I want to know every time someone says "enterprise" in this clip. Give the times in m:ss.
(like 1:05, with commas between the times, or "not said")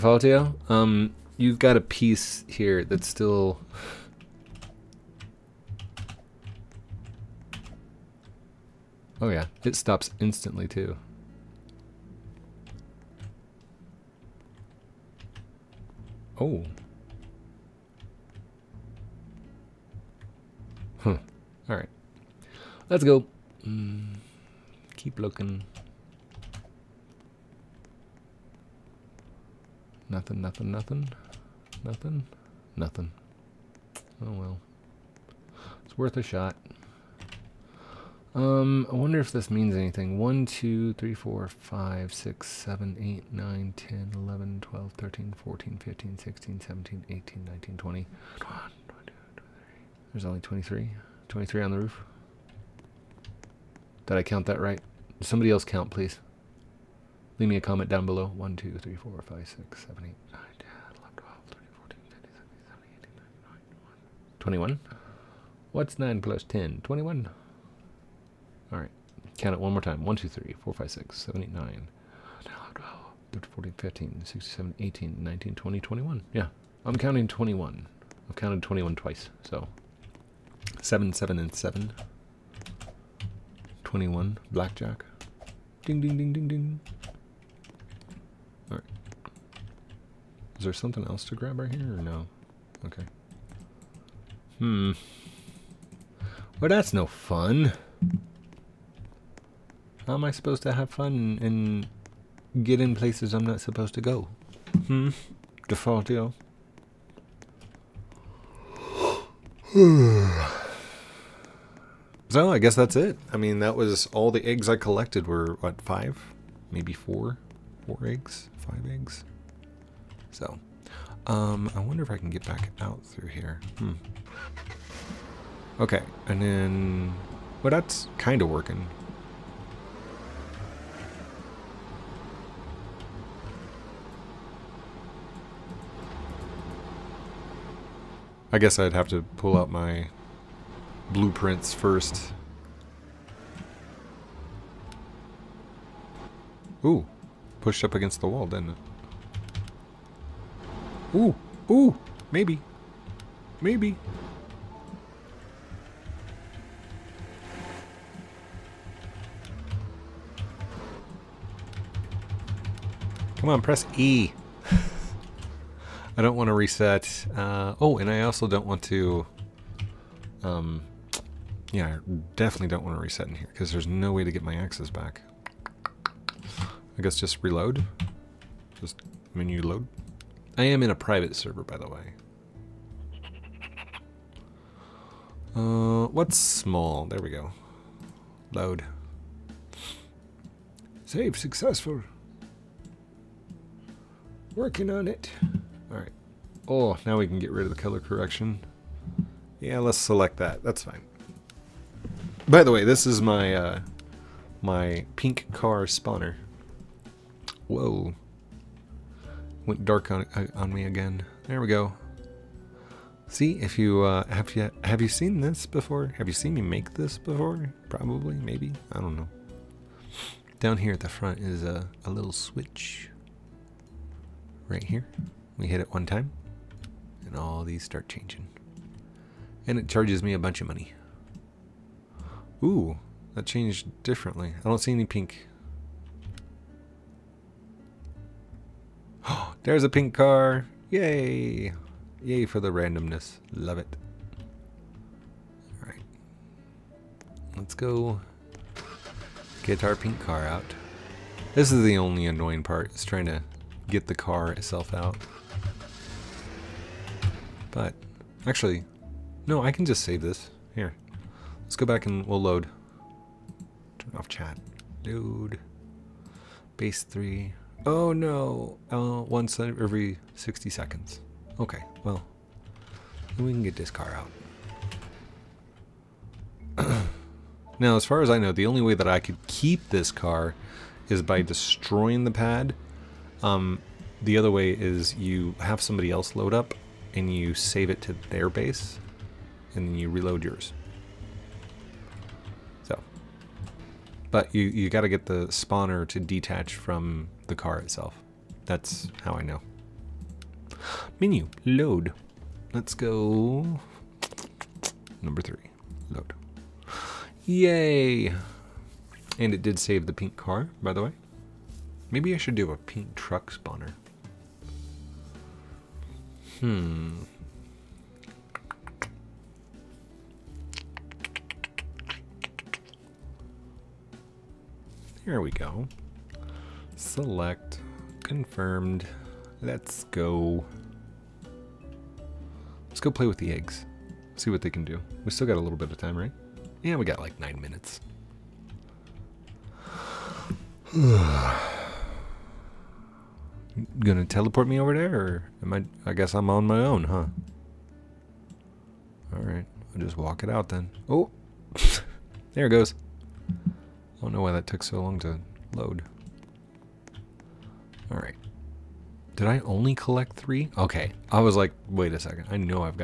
not said.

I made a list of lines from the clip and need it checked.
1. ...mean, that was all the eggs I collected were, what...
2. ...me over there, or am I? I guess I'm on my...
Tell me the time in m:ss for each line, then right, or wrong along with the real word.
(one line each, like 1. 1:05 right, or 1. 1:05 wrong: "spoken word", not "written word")
1. 1:53 right
2. 5:44 right.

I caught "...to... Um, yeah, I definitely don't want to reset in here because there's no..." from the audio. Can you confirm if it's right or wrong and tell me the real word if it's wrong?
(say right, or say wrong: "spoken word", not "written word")
right.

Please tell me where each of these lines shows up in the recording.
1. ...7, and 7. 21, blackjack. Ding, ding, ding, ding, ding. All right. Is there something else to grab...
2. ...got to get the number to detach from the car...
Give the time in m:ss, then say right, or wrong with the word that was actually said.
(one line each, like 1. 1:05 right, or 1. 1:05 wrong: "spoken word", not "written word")
1. 1:21 right
2. 4:54 wrong: "spawner", not "number".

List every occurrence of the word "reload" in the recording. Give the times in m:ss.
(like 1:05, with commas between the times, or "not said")
2:57, 4:50.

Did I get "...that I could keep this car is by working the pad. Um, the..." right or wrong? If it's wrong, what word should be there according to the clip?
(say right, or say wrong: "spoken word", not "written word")
wrong: "destroying", not "working".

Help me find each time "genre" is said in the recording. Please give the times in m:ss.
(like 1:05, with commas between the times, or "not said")
not said.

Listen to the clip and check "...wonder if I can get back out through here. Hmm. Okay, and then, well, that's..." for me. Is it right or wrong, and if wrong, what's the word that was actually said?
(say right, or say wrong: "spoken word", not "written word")
right.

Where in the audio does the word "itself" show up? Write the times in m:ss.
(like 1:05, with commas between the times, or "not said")
4:14, 4:57.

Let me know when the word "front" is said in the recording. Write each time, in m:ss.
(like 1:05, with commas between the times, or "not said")
3:41.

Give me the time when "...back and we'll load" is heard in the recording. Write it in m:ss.
4:21.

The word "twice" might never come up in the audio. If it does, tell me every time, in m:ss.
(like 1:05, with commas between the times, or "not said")
1:18.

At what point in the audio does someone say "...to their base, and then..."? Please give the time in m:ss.
4:48.